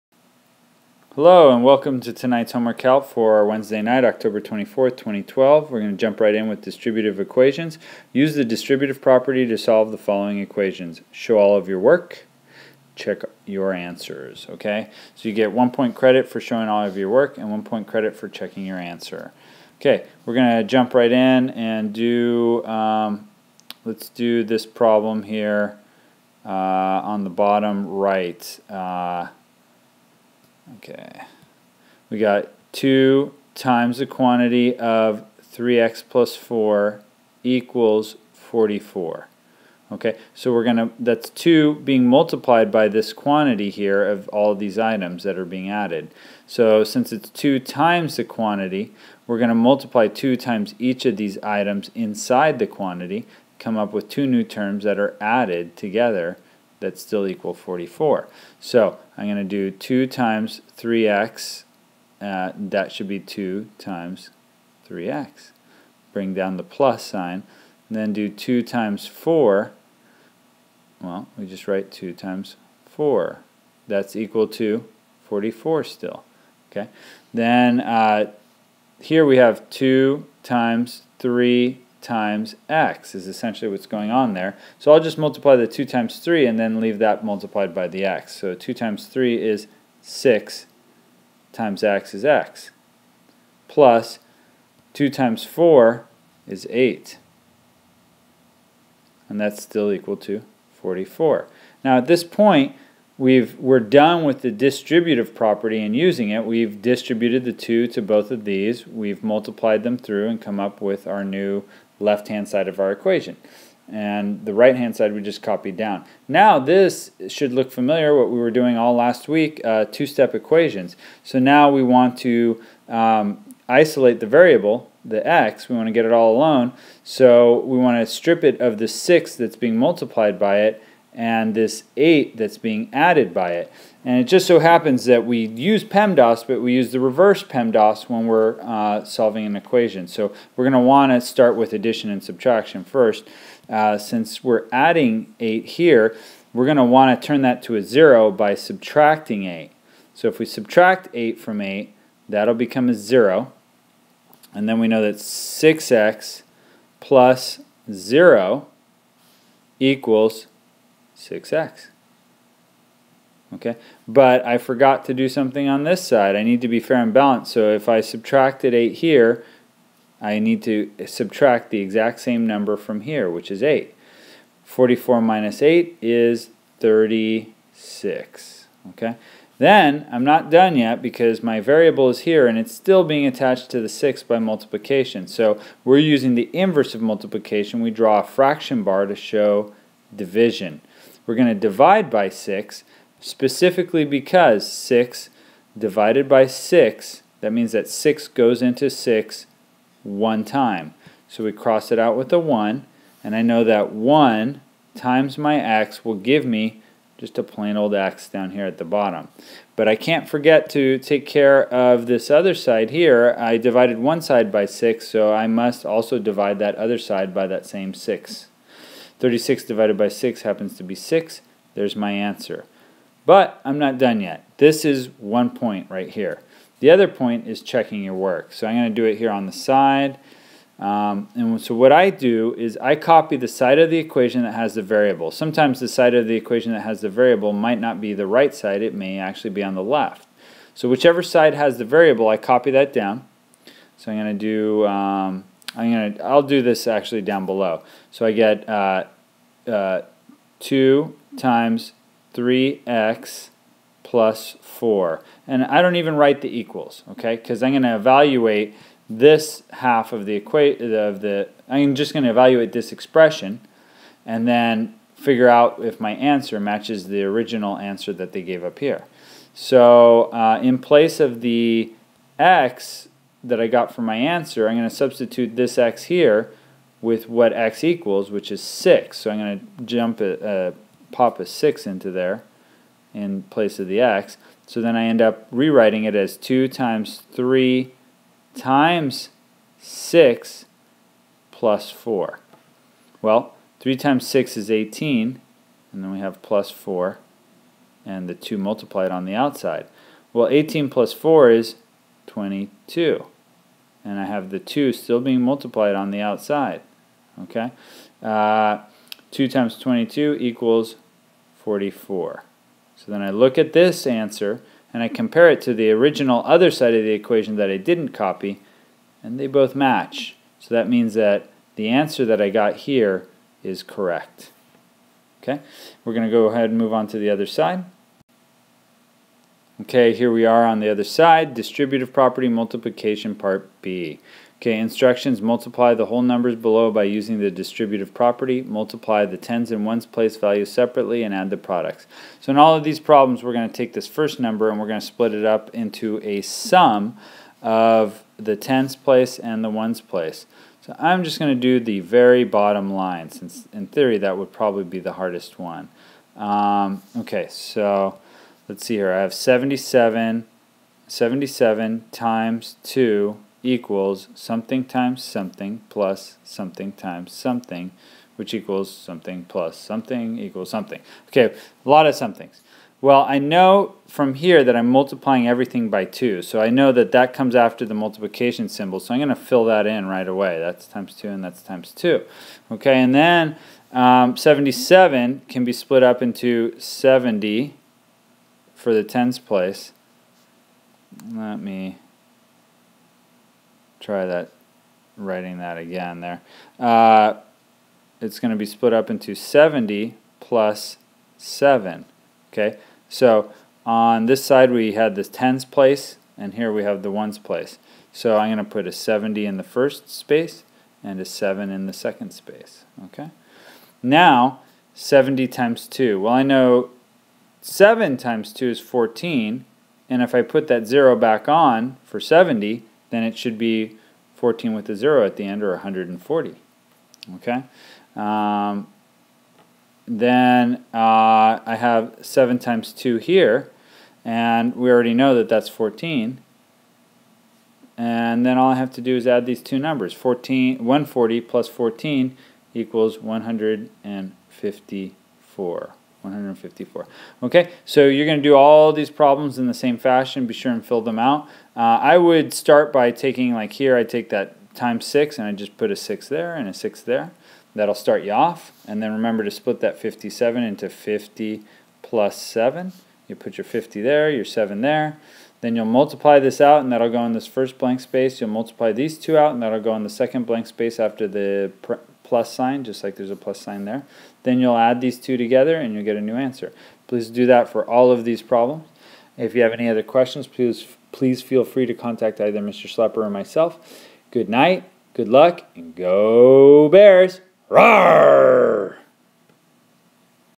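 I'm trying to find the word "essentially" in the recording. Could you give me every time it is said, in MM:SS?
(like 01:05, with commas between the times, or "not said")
01:23.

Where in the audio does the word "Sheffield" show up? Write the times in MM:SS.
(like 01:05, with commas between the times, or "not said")
not said.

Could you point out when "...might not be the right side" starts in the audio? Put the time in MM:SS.
03:57.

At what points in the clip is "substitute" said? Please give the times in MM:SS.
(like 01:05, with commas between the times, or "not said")
04:34.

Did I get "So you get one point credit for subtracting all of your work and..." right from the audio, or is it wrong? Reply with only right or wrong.
wrong.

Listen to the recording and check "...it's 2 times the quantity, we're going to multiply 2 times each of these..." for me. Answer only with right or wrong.
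right.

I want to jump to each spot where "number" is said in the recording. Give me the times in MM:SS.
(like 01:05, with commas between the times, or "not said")
02:52, 05:36, 05:44, 07:19.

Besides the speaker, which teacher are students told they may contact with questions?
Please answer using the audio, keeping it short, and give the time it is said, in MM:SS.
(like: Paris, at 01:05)
Mr. Schlepper, at 08:02.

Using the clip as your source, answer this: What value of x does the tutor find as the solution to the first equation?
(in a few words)
6.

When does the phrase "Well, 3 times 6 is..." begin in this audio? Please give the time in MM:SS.
04:53.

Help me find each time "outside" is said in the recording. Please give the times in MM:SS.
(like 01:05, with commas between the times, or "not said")
04:59, 05:06.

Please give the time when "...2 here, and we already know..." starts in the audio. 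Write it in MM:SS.
07:12.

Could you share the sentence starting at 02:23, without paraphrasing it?
Uh, since we're adding 8 here, we're going to want to turn that to a 0 by subtracting 8.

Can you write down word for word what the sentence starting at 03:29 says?
But I can't forget to take care of this other side here.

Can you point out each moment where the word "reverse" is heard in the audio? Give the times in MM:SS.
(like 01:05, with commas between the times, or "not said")
02:16.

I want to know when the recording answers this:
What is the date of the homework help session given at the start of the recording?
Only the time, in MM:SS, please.
00:04.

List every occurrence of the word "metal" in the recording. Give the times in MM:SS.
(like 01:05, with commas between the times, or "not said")
not said.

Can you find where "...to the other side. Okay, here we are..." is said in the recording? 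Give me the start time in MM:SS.
05:27.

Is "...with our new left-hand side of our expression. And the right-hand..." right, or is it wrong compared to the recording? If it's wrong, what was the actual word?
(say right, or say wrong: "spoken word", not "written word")
wrong: "equation", not "expression".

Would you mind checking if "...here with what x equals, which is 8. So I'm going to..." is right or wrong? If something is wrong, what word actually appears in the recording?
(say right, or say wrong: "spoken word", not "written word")
wrong: "6", not "8".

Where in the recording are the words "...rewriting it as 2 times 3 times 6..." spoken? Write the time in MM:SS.
04:45.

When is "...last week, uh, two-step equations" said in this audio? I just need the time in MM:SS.
01:58.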